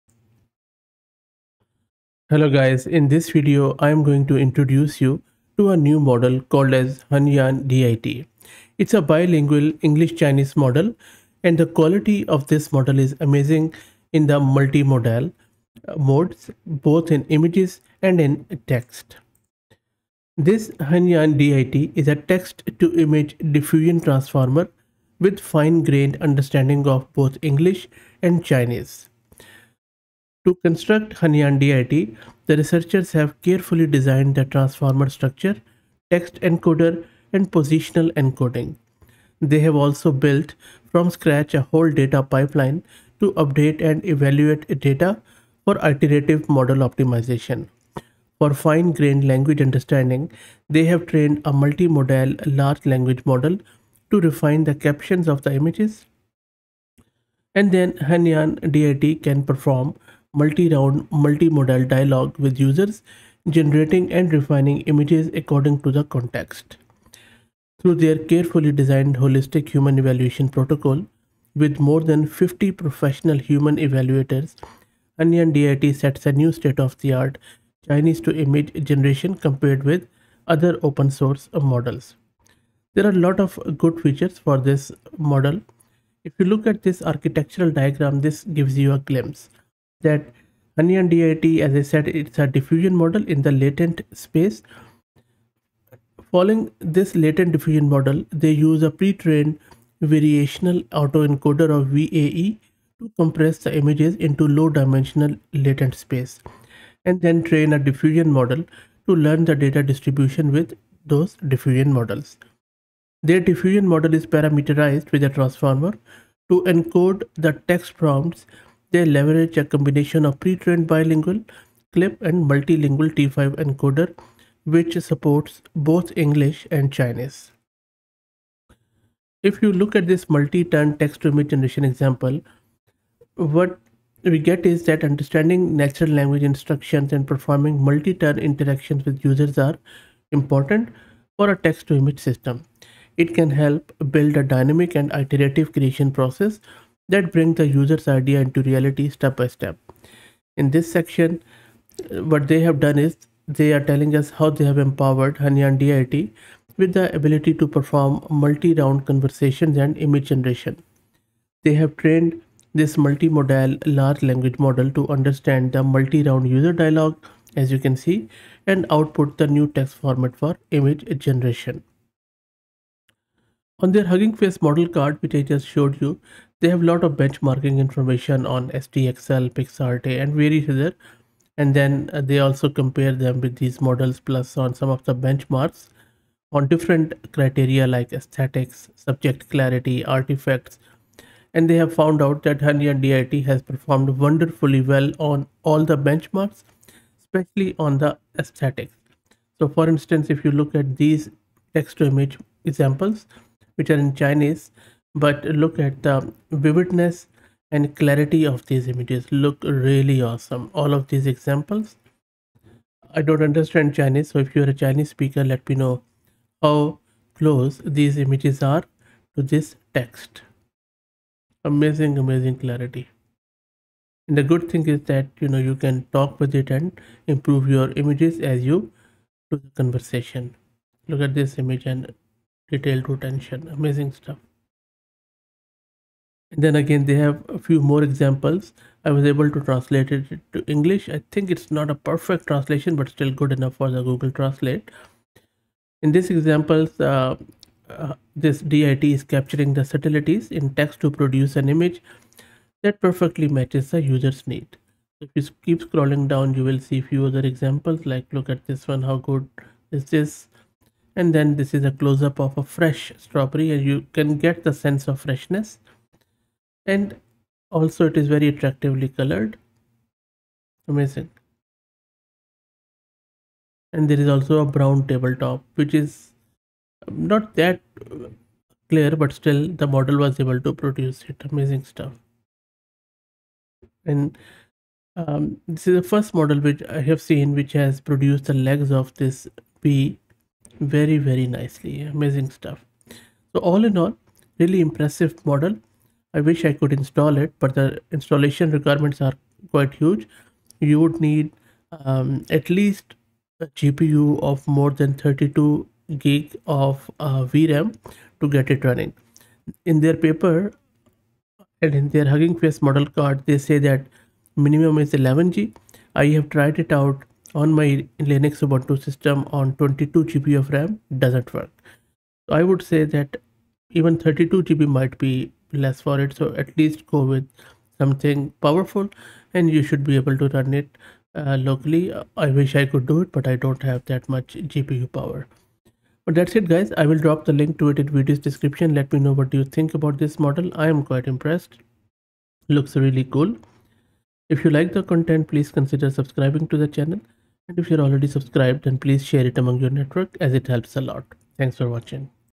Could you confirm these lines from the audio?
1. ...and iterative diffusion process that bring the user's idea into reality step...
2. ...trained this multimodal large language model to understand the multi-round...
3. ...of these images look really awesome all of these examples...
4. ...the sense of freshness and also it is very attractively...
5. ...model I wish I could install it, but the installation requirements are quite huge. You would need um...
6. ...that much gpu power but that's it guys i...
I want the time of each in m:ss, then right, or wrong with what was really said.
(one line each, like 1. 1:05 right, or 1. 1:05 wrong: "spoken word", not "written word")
1. 2:24 wrong: "creation", not "diffusion"
2. 2:41 right
3. 3:28 right
4. 4:24 right
5. 4:55 right
6. 5:34 right.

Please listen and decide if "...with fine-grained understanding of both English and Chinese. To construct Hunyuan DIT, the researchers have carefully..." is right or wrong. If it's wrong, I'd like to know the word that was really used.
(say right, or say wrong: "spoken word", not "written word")
right.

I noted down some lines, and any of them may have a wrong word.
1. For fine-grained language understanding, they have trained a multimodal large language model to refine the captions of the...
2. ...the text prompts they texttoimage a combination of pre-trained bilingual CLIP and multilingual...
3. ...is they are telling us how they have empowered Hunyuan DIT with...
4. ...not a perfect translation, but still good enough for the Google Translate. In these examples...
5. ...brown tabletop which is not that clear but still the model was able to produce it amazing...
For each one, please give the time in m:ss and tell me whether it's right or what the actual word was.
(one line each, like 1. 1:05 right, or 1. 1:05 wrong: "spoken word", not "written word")
1. 0:48 right
2. 1:57 wrong: "leverage", not "texttoimage"
3. 2:32 right
4. 4:01 right
5. 4:34 right.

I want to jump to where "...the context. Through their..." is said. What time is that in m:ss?
1:05.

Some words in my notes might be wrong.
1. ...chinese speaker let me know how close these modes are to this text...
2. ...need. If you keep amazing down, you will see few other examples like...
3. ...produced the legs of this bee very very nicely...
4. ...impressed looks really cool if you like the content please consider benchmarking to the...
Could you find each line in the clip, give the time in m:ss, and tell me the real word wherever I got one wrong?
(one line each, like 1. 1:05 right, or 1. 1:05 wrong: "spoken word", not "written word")
1. 3:34 wrong: "images", not "modes"
2. 4:14 wrong: "scrolling", not "amazing"
3. 4:48 right
4. 5:41 wrong: "subscribing", not "benchmarking".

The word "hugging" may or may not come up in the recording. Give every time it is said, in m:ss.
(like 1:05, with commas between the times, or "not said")
2:54, 5:12.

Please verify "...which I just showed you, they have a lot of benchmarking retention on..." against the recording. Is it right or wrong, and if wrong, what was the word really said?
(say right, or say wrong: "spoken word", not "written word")
wrong: "information", not "retention".